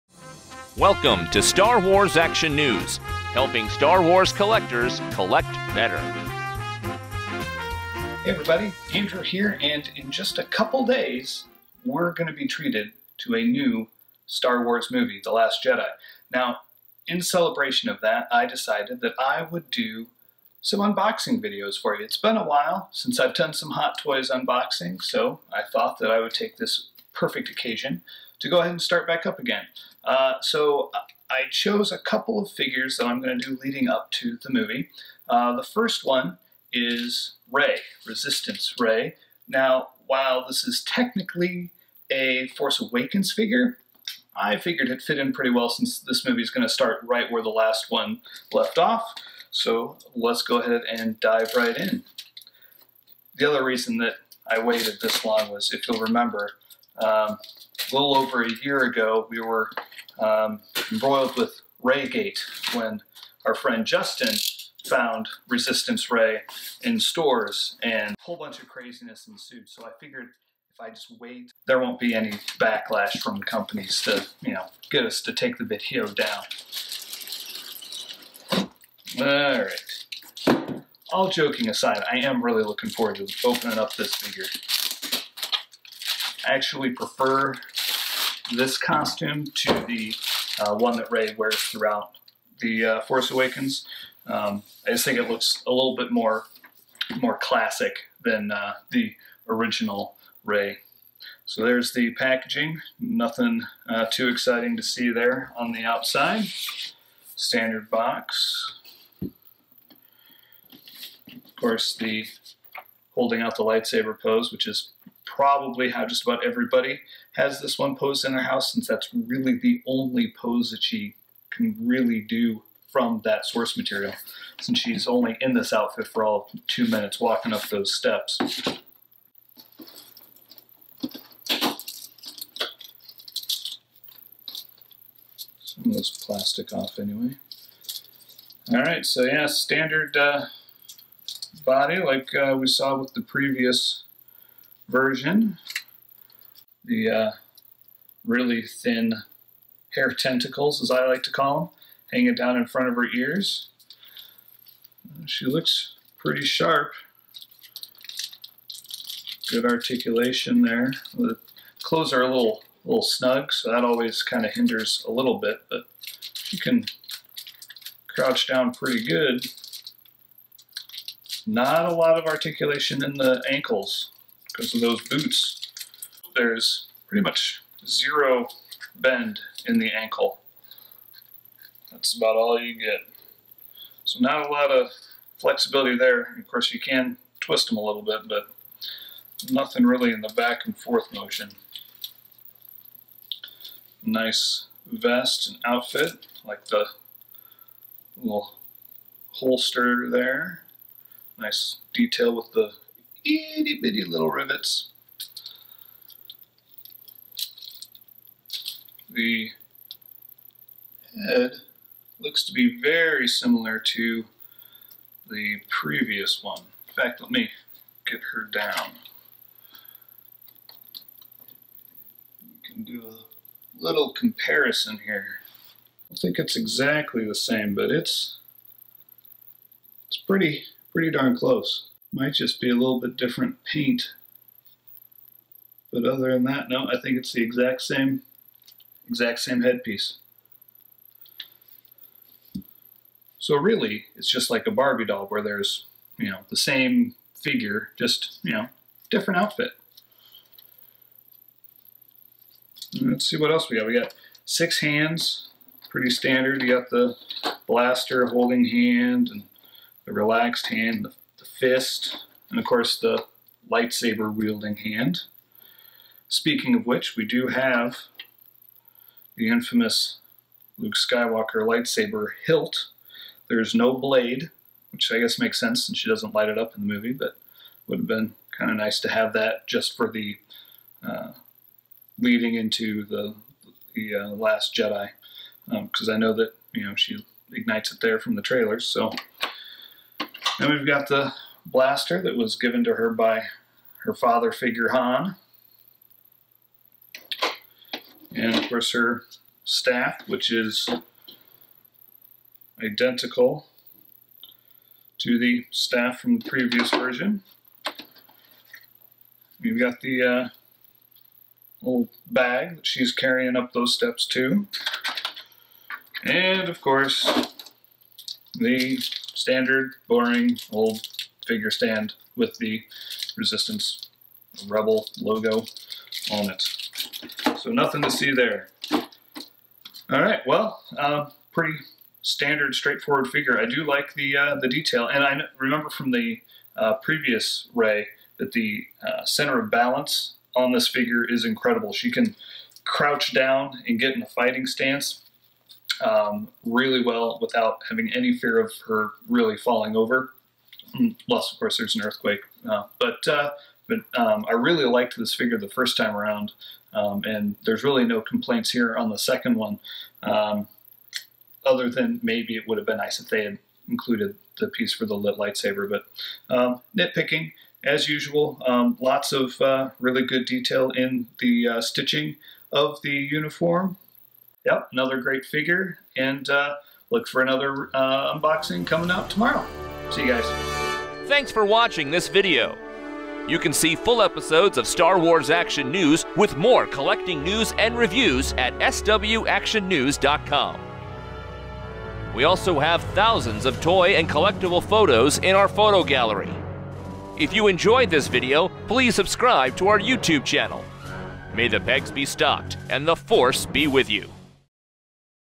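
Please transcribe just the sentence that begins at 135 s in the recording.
Some of this plastic off anyway.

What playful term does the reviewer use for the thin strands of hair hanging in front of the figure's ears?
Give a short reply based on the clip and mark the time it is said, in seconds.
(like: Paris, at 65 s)
hair tentacles, at 149 s.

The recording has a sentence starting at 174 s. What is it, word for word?
Because in those boots, there's pretty much zero bend in the ankle.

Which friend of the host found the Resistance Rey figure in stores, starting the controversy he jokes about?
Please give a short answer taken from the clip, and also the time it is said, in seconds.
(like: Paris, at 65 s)
Justin, at 63 s.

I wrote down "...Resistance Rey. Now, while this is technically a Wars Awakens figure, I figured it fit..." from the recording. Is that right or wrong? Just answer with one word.
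wrong.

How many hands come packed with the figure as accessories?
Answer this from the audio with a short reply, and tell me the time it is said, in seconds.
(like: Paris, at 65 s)
6, at 254 s.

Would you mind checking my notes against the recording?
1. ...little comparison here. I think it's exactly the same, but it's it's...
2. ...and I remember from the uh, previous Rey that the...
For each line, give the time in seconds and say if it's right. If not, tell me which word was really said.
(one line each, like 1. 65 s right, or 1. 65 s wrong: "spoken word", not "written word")
1. 223 s right
2. 335 s right.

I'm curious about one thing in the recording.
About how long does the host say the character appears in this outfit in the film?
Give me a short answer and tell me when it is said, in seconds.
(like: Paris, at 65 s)
2 minutes, at 126 s.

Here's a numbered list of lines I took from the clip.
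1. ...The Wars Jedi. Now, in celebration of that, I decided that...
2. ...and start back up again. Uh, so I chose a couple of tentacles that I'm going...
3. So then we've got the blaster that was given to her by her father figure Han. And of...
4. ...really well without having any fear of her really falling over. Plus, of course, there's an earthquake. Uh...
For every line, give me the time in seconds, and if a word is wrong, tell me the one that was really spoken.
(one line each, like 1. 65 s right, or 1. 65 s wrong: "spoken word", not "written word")
1. 15 s wrong: "Last", not "Wars"
2. 28 s wrong: "figures", not "tentacles"
3. 288 s right
4. 346 s right.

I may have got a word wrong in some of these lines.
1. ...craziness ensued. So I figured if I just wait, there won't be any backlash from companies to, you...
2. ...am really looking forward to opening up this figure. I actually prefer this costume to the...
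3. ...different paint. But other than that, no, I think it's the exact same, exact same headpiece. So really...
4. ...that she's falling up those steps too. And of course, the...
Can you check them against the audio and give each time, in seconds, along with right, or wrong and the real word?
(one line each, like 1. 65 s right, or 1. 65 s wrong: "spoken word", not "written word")
1. 68 s right
2. 82 s right
3. 233 s right
4. 312 s wrong: "carrying", not "falling".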